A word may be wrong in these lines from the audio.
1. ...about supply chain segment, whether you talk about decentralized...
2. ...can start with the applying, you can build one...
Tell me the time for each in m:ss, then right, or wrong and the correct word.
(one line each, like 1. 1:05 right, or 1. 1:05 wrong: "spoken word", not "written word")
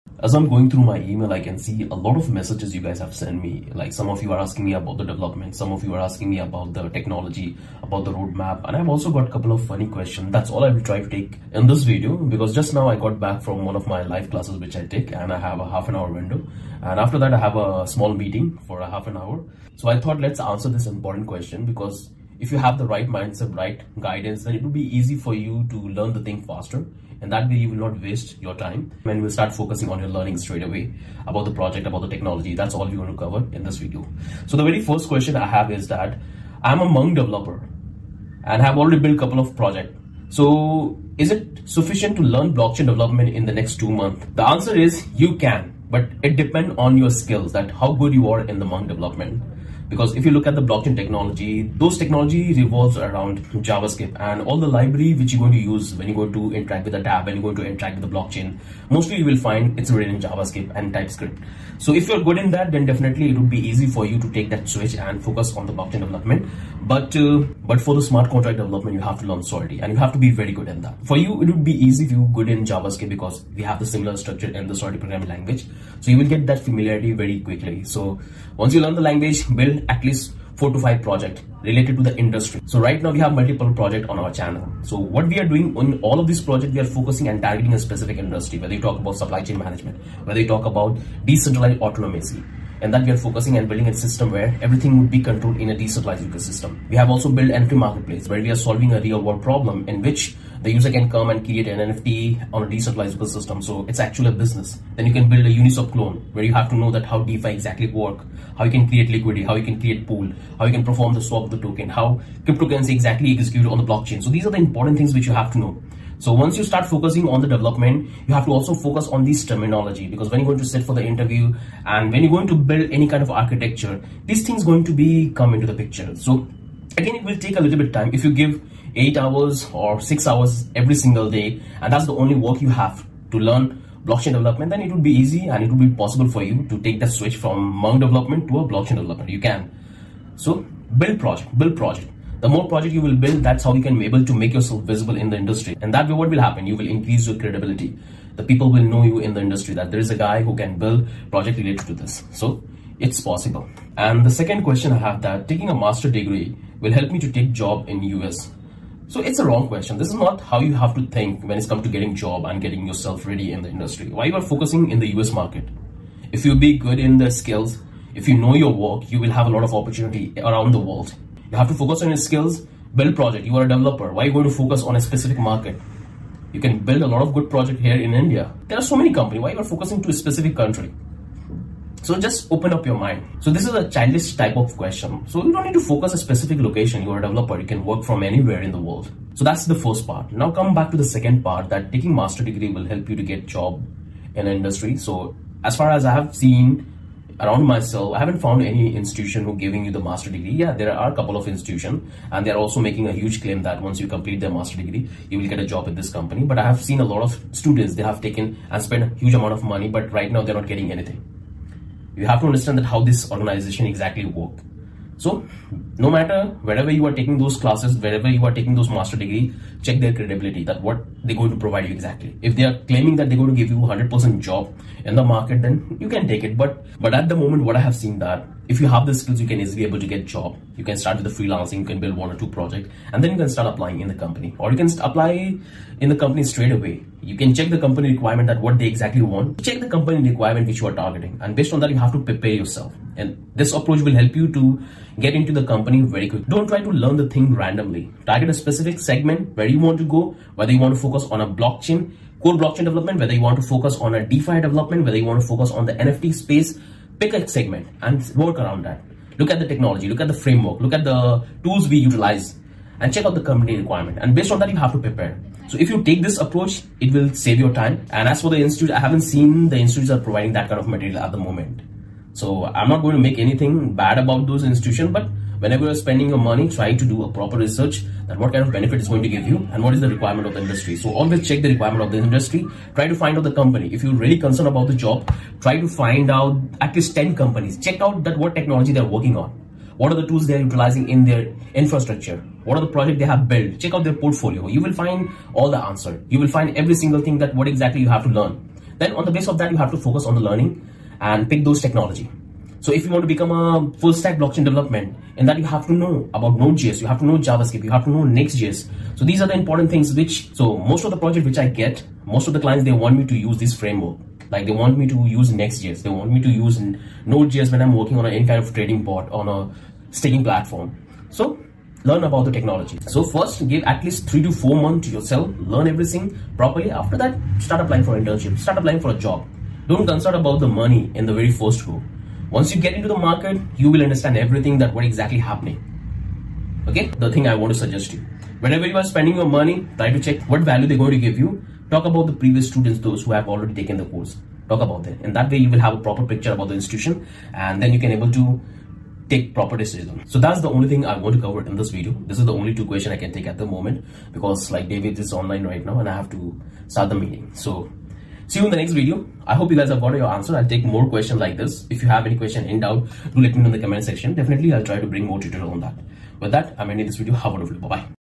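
1. 1:28 wrong: "management", not "segment"
2. 3:50 wrong: "freelancing", not "applying".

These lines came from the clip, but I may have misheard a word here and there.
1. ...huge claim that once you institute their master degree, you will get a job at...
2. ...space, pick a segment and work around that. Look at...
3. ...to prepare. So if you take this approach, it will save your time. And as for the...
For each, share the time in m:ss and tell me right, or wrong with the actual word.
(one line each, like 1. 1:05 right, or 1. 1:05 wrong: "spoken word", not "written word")
1. 3:23 wrong: "complete", not "institute"
2. 4:16 right
3. 4:24 right.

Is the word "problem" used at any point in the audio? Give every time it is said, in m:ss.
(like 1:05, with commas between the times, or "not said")
1:39.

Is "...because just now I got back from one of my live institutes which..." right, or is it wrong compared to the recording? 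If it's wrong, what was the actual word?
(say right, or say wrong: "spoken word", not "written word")
wrong: "classes", not "institutes".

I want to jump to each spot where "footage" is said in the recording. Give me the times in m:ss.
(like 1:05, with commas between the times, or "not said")
not said.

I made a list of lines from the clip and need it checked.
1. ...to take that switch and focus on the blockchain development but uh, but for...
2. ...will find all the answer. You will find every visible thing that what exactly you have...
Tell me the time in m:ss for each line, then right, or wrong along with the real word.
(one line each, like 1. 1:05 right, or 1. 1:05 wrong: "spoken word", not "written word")
1. 1:04 right
2. 4:54 wrong: "single", not "visible".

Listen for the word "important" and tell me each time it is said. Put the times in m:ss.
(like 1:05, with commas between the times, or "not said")
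0:20, 1:54, 5:09.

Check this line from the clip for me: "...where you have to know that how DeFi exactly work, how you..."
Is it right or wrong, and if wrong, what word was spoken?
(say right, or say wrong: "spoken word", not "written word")
right.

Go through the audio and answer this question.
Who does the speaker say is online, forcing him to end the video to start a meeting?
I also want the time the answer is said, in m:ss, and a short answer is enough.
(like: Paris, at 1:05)
David, at 5:54.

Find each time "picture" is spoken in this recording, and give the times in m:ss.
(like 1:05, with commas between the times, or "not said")
2:05, 5:46.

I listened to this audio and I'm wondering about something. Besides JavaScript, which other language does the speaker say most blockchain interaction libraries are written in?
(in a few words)
TypeScript.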